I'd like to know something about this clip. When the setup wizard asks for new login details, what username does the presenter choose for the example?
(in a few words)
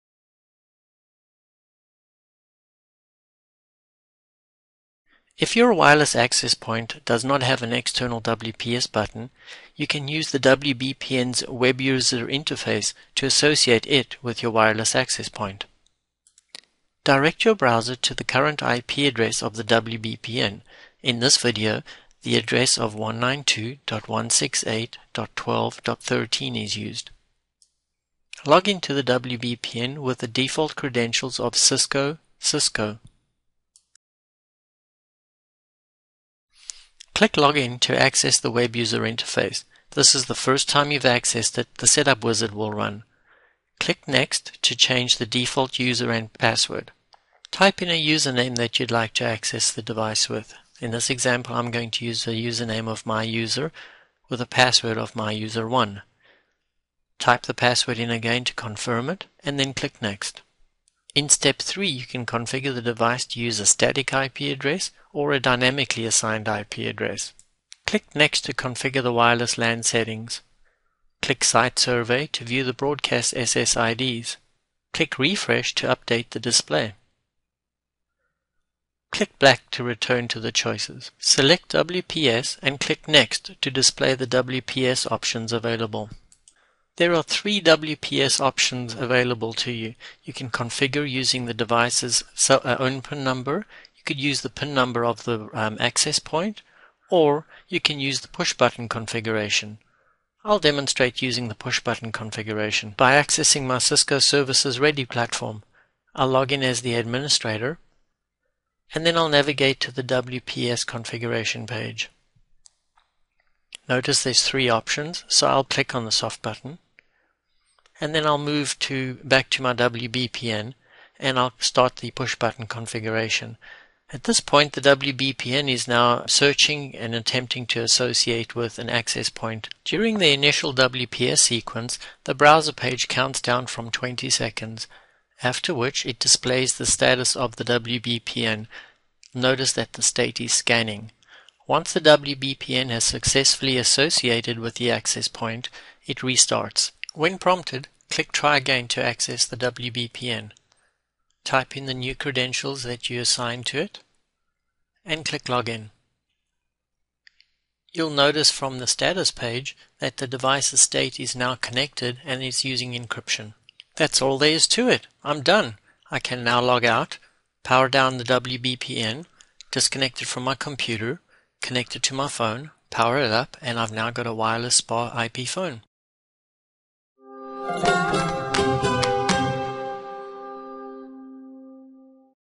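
my user.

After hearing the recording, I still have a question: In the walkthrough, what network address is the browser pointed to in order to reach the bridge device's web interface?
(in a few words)
192.168.12.13.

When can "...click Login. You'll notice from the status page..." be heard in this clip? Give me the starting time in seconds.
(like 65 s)
155 s.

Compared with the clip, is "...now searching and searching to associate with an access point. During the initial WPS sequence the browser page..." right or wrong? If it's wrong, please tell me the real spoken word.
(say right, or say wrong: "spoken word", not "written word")
wrong: "attempting", not "searching".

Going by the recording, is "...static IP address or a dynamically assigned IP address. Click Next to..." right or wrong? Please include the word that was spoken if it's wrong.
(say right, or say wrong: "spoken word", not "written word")
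right.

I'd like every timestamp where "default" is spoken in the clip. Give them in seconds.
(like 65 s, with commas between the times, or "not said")
30 s, 45 s.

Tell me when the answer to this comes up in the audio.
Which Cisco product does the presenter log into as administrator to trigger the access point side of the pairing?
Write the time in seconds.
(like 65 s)
103 s.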